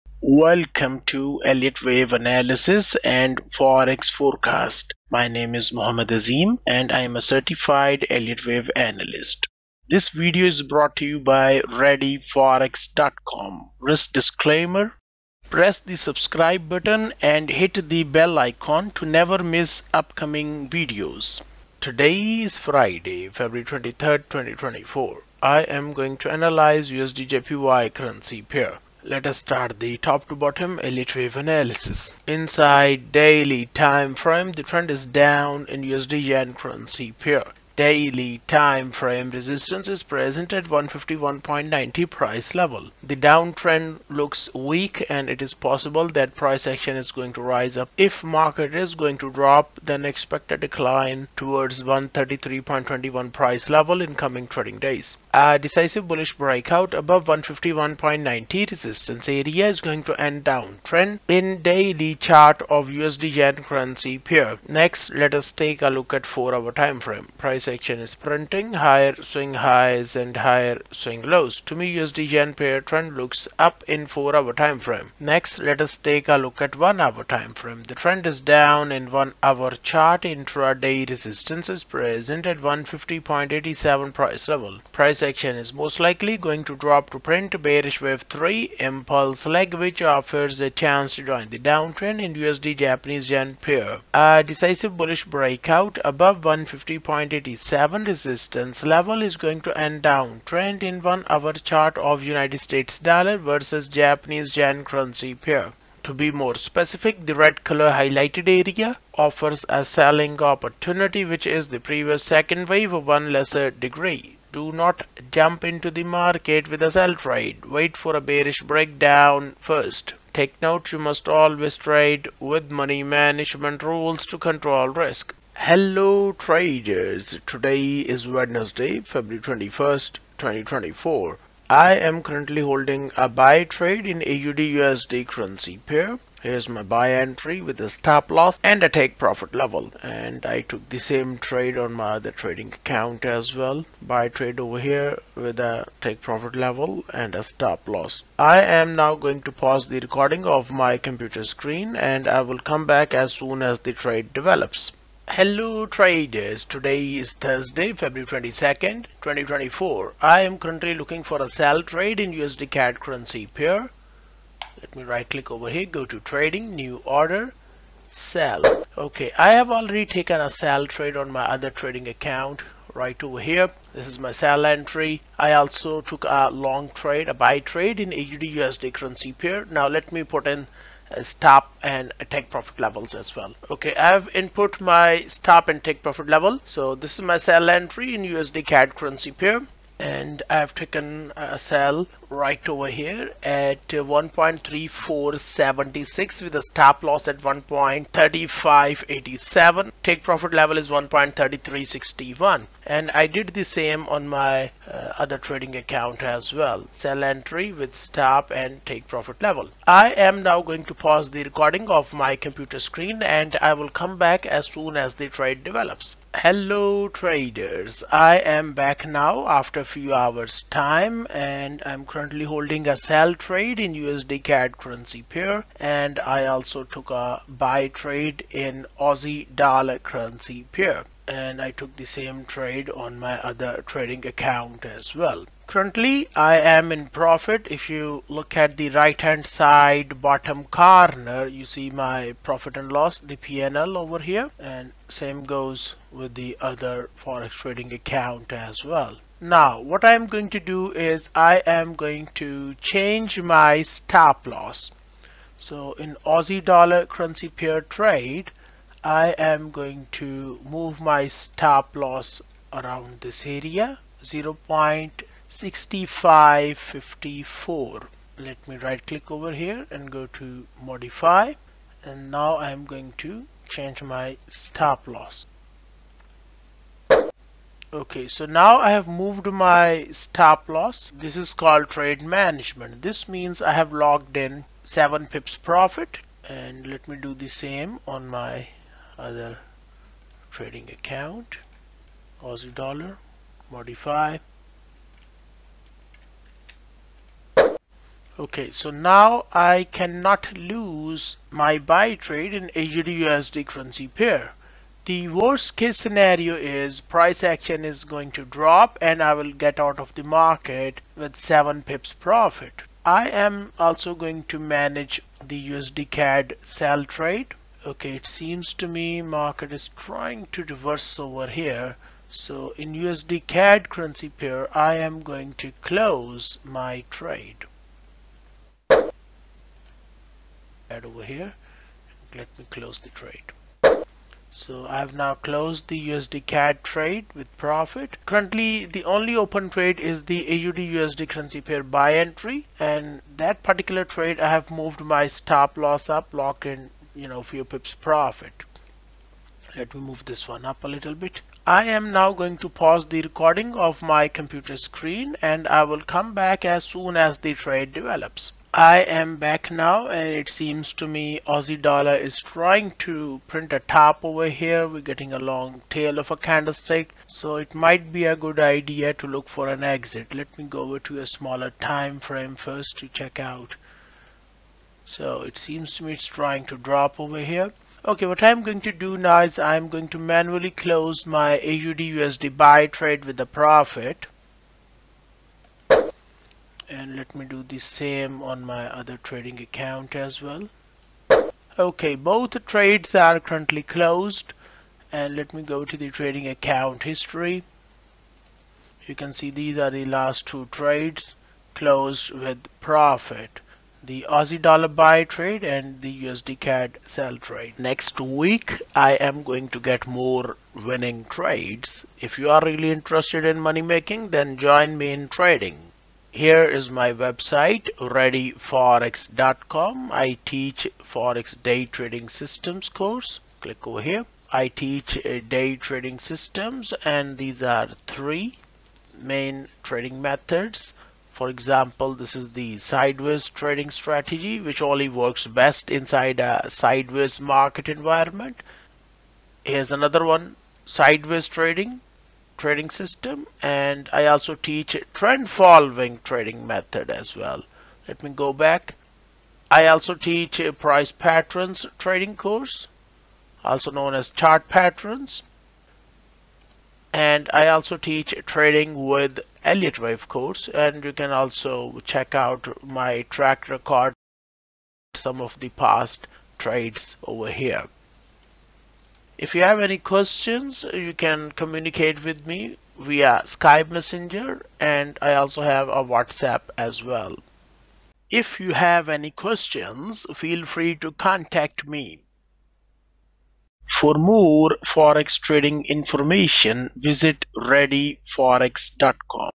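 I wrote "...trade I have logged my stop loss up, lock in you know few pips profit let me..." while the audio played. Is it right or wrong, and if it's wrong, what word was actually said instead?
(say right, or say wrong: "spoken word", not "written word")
wrong: "moved", not "logged".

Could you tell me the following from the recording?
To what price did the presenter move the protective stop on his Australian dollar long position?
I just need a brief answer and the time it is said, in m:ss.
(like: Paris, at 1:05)
0.6554, at 4:24.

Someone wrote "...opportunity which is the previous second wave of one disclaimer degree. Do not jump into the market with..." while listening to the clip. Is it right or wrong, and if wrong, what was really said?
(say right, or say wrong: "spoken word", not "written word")
wrong: "lesser", not "disclaimer".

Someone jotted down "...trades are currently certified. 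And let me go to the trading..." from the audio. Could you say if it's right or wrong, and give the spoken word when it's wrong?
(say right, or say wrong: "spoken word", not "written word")
wrong: "closed", not "certified".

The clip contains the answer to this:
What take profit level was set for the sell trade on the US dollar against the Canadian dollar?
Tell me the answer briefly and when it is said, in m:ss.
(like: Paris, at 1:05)
1.3361, at 3:20.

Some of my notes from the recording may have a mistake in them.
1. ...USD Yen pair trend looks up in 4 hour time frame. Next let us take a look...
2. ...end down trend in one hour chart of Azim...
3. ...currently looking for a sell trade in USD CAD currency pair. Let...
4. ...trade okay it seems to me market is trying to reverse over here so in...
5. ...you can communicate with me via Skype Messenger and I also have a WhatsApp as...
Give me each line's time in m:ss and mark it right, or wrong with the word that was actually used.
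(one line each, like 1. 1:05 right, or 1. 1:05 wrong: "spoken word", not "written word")
1. 1:11 right
2. 1:39 wrong: "United", not "Azim"
3. 2:40 right
4. 5:17 right
5. 7:50 right.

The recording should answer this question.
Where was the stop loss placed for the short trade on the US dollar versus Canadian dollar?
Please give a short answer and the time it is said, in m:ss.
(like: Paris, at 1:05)
1.3587, at 3:17.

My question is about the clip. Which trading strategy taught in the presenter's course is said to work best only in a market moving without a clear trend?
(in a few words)
sideways trading strategy.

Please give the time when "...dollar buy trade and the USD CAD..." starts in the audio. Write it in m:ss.
6:44.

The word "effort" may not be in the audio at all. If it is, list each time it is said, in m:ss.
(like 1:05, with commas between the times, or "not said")
not said.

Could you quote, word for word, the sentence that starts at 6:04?
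We're getting a long tail of a candlestick.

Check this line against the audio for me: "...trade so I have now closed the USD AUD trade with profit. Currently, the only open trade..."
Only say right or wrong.
wrong.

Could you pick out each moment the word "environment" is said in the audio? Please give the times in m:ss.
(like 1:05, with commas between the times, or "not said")
7:17.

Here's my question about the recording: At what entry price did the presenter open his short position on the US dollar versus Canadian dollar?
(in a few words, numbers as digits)
1.3476.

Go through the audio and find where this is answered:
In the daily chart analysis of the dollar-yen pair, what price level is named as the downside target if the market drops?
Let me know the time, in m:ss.
0:51.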